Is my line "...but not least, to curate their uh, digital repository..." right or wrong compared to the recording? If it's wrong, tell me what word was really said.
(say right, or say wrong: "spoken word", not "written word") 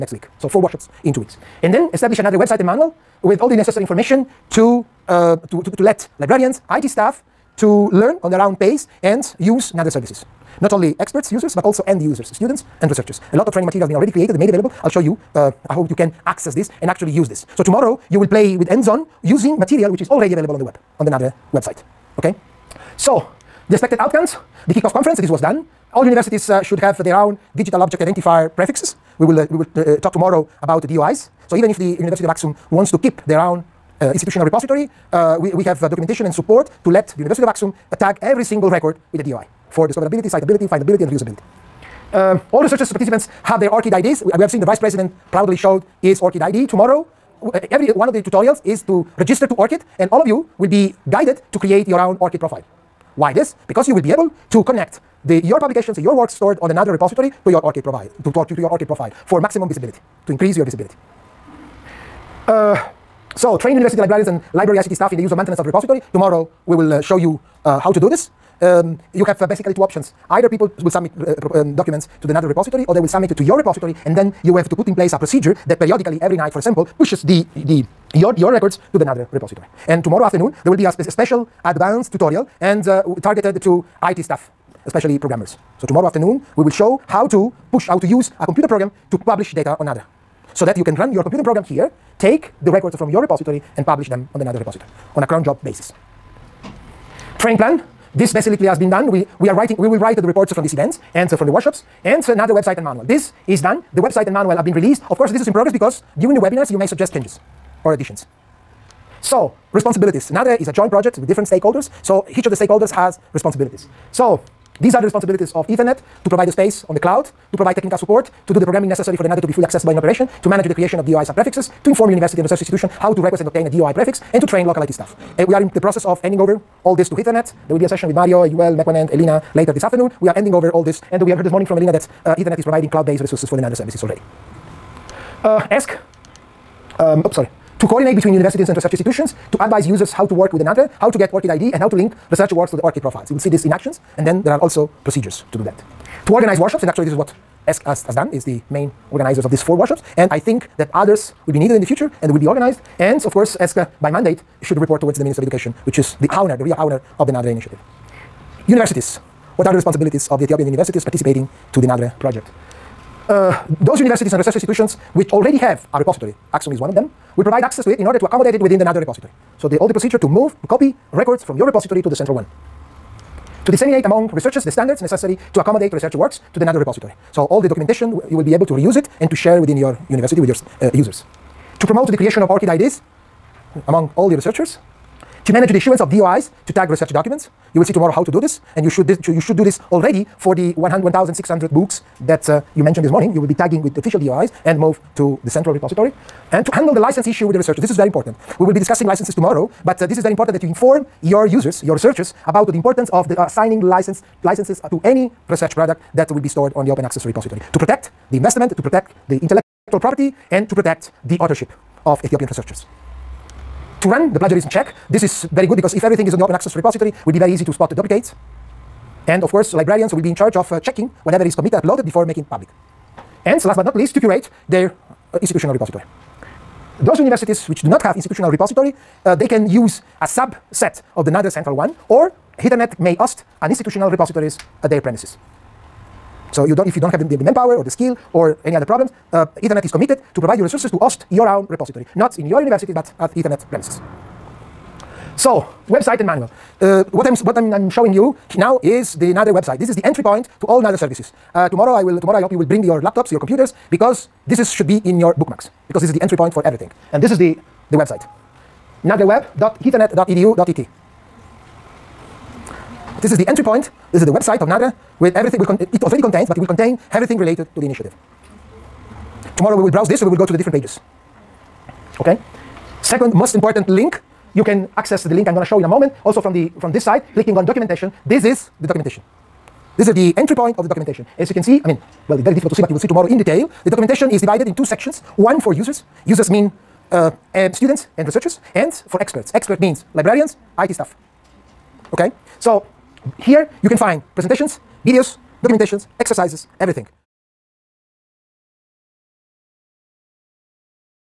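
wrong: "institutional", not "digital".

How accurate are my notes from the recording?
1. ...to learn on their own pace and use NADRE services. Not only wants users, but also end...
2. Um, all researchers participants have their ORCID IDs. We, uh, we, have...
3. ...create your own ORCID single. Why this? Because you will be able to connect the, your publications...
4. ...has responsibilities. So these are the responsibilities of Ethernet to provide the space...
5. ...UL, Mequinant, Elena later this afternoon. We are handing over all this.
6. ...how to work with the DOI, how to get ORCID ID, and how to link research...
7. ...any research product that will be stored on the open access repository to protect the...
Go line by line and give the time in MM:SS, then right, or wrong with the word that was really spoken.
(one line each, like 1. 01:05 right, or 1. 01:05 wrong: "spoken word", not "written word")
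1. 00:07 wrong: "experts", not "wants"
2. 00:42 right
3. 00:51 wrong: "profile", not "single"
4. 01:52 right
5. 02:08 right
6. 02:20 wrong: "NADRE", not "DOI"
7. 03:25 right.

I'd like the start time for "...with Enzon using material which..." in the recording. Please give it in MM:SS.
00:18.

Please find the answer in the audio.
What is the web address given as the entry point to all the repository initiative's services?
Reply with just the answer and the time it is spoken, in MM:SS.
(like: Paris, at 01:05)
nadreweb.ethernet.edu.et, at 04:19.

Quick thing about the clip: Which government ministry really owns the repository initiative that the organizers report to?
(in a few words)
Minister of Education.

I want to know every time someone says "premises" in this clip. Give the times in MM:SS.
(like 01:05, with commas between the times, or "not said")
03:54, 04:03.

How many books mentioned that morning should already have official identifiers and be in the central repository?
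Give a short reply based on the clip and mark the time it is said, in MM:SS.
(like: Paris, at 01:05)
1,600, at 03:10.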